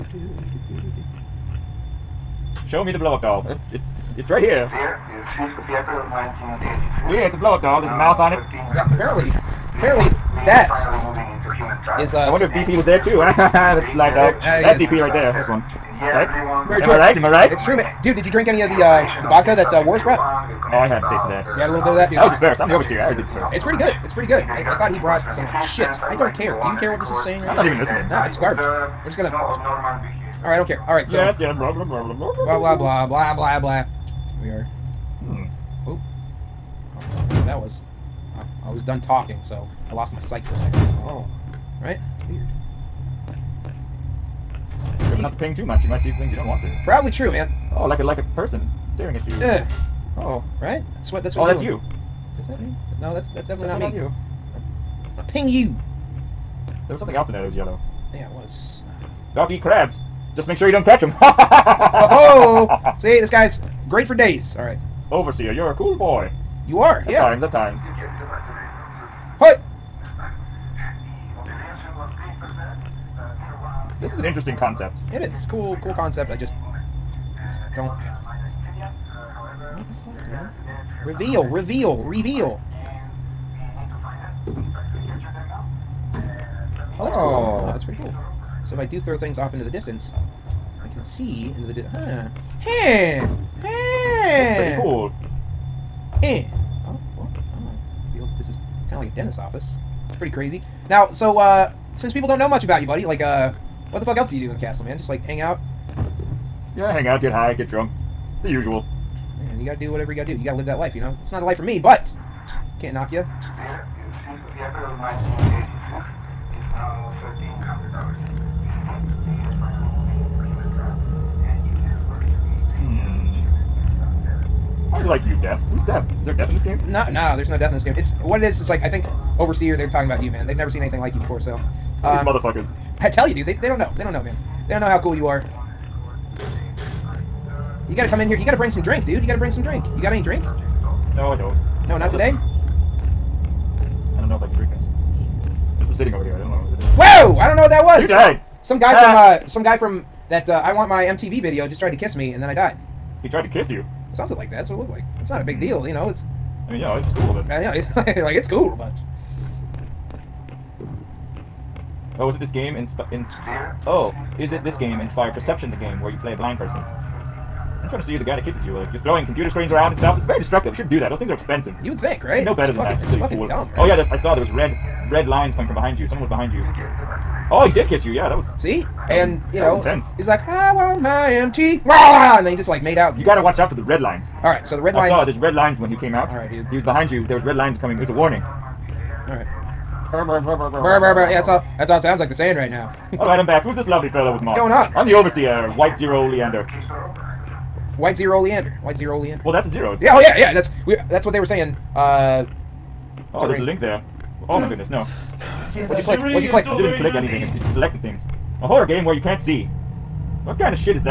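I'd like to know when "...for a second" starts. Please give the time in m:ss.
0:40.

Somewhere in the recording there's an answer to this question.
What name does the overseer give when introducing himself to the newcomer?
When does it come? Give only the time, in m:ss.
3:15.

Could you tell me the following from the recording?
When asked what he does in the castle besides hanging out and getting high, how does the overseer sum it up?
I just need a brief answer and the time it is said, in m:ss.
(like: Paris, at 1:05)
The usual, at 1:48.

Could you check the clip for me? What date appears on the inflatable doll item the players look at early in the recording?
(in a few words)
5th of April 1986.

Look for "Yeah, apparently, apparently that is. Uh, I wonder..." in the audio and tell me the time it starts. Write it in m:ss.
0:08.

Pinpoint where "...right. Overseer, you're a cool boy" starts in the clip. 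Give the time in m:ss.
1:04.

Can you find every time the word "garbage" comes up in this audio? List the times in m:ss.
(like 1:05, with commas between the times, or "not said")
0:28.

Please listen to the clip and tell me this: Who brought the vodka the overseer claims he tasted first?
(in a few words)
Warris.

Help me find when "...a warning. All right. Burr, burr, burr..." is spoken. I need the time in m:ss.
3:08.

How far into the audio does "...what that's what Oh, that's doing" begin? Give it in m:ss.
0:51.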